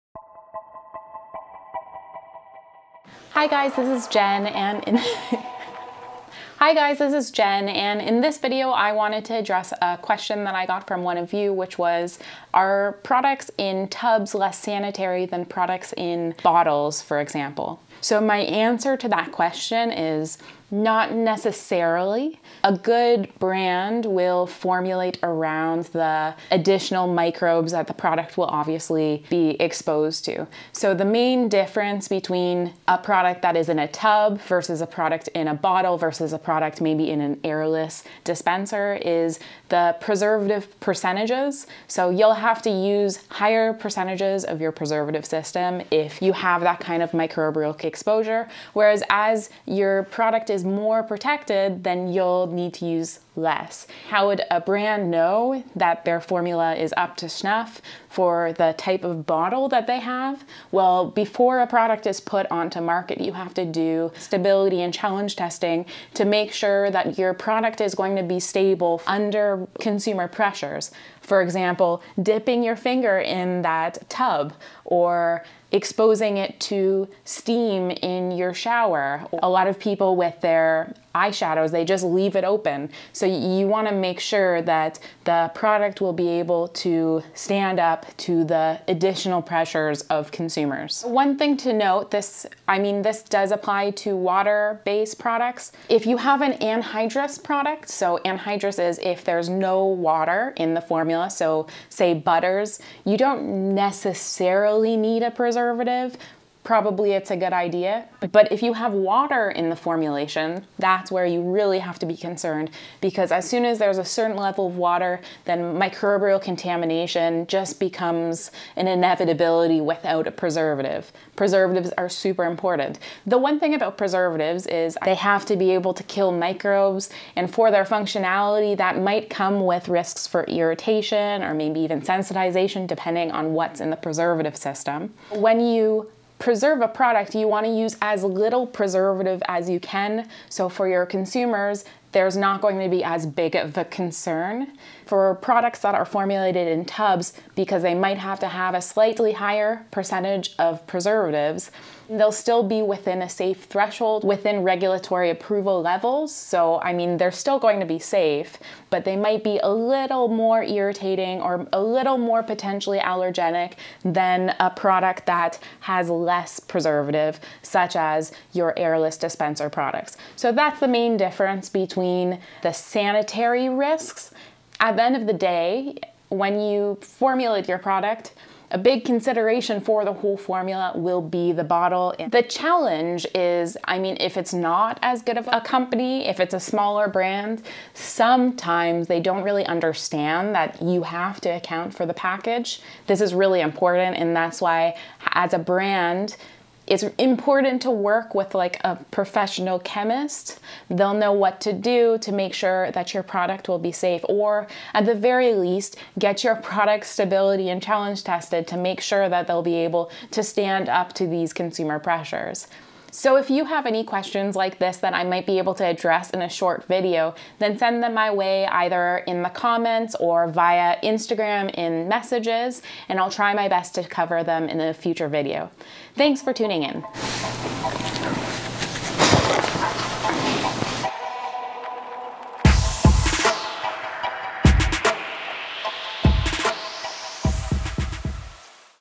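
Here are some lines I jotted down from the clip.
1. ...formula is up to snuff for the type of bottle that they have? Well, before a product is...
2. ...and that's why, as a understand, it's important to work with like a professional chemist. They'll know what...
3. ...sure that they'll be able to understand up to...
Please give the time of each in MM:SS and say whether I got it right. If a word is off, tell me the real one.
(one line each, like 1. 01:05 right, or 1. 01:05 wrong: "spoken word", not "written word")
1. 00:56 right
2. 03:14 wrong: "brand", not "understand"
3. 03:29 wrong: "stand", not "understand".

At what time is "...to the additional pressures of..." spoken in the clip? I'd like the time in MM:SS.
01:28.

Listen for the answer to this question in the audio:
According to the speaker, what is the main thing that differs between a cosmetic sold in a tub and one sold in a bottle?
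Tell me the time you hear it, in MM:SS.
00:39.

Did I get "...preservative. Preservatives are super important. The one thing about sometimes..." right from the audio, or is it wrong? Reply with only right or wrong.
wrong.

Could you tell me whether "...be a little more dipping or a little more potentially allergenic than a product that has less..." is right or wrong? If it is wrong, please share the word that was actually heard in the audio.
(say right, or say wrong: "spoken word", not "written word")
wrong: "irritating", not "dipping".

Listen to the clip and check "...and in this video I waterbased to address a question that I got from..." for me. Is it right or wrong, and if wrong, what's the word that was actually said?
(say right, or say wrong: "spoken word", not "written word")
wrong: "wanted", not "waterbased".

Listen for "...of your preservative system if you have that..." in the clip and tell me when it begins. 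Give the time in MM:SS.
00:44.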